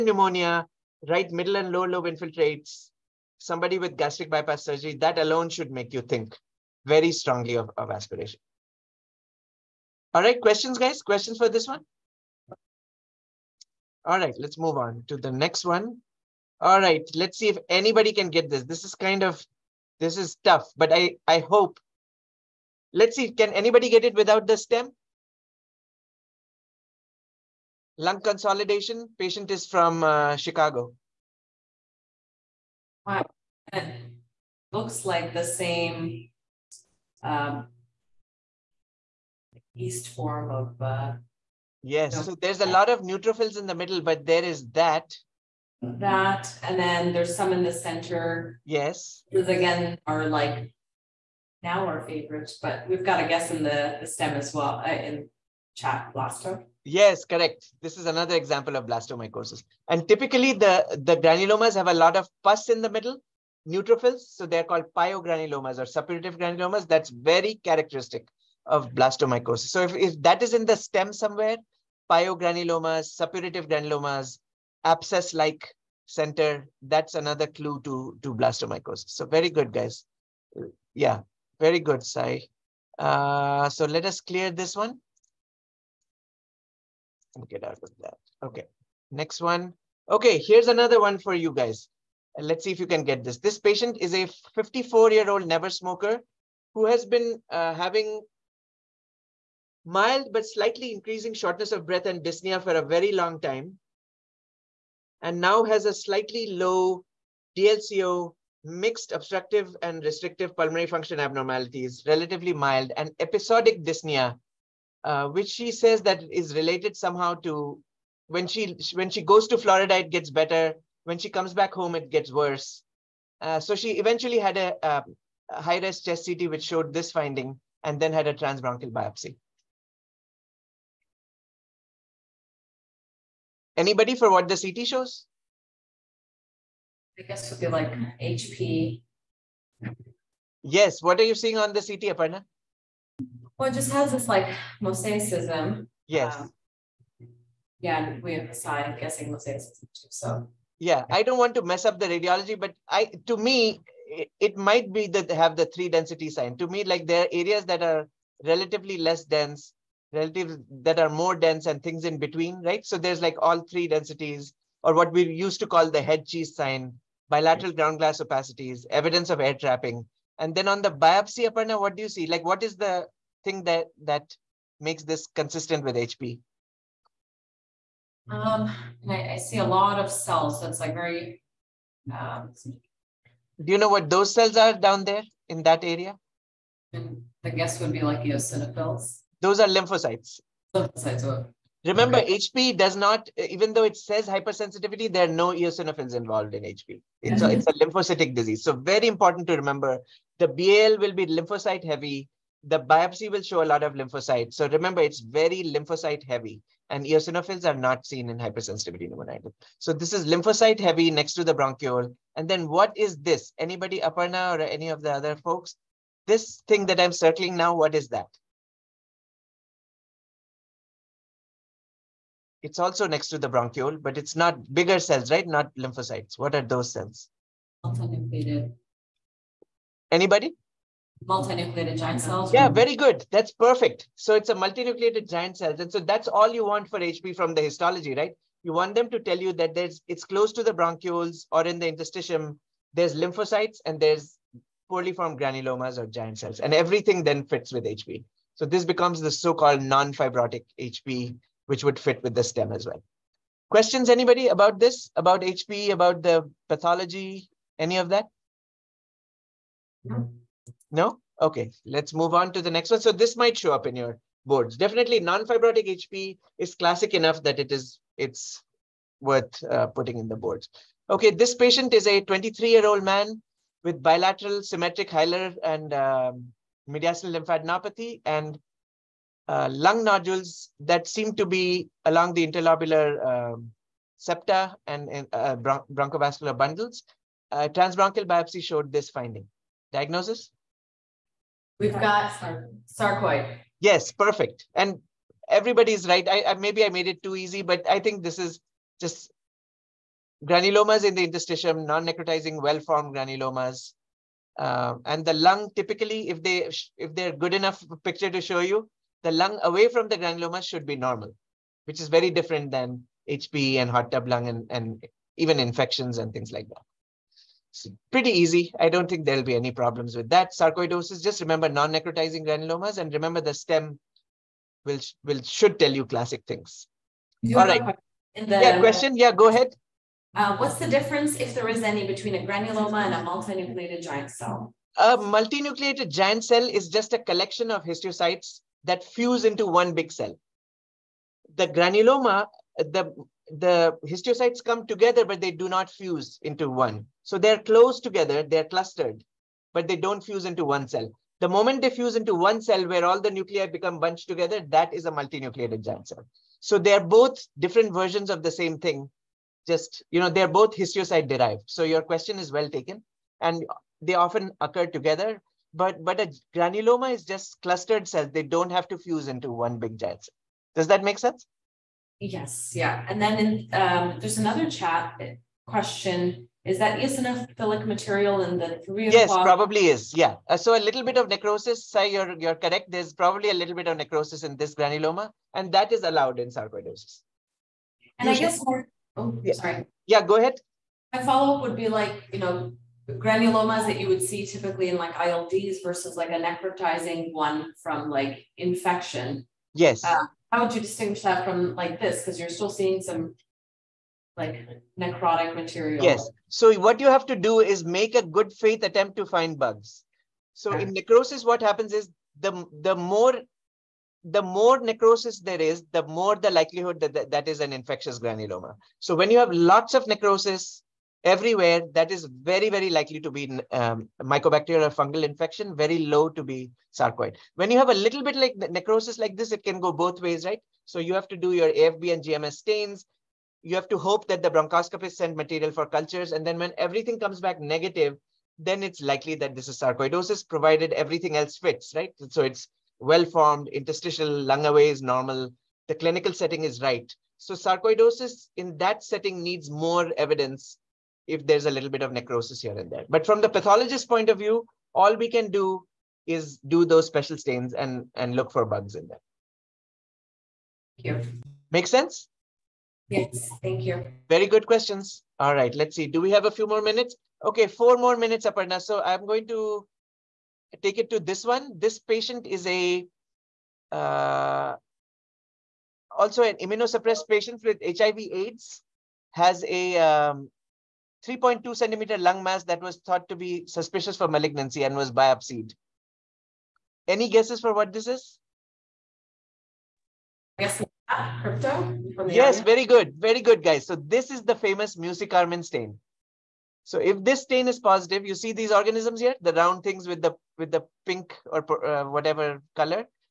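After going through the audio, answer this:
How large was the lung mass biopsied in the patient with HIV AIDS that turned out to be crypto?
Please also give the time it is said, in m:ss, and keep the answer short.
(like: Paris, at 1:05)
3.2 centimeters, at 8:01.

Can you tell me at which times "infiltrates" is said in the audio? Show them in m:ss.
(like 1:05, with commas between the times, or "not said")
0:02.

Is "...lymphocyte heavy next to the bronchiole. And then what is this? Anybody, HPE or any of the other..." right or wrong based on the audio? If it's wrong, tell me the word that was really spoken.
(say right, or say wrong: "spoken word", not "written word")
wrong: "Aparna", not "HPE".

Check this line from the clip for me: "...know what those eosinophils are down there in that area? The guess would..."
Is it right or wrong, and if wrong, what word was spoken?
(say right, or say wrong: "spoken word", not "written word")
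wrong: "cells", not "eosinophils".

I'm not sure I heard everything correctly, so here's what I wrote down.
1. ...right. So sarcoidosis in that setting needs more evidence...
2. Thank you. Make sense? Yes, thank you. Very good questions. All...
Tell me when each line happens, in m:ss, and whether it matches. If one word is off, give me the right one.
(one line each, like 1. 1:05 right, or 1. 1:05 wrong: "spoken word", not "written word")
1. 7:26 right
2. 7:41 right.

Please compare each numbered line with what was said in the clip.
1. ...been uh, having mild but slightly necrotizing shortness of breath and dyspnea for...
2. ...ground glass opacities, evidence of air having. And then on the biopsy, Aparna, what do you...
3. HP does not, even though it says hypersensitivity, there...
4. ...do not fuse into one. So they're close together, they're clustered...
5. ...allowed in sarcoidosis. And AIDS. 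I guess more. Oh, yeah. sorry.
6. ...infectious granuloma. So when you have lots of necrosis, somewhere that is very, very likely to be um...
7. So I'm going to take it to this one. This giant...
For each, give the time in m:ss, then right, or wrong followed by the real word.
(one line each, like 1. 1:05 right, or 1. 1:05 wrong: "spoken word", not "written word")
1. 1:37 wrong: "increasing", not "necrotizing"
2. 2:47 wrong: "trapping", not "having"
3. 3:12 right
4. 5:45 right
5. 6:26 wrong: "Usually", not "AIDS"
6. 6:57 wrong: "everywhere", not "somewhere"
7. 7:48 wrong: "patient", not "giant".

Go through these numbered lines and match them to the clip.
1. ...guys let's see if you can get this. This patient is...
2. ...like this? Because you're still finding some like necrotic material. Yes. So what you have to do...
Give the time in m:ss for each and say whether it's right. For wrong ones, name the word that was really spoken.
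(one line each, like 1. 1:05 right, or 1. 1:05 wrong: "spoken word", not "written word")
1. 1:31 right
2. 6:41 wrong: "seeing", not "finding".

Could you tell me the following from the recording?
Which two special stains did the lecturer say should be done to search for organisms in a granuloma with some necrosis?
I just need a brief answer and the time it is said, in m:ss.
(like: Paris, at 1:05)
AFB and GMS, at 7:11.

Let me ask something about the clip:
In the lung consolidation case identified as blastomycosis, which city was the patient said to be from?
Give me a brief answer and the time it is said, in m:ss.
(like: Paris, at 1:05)
Chicago, at 0:30.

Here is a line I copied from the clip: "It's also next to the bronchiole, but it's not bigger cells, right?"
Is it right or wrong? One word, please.
right.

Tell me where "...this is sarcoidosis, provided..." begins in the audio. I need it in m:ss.
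7:19.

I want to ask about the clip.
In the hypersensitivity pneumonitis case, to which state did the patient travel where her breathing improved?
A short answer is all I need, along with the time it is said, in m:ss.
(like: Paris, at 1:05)
Florida, at 1:59.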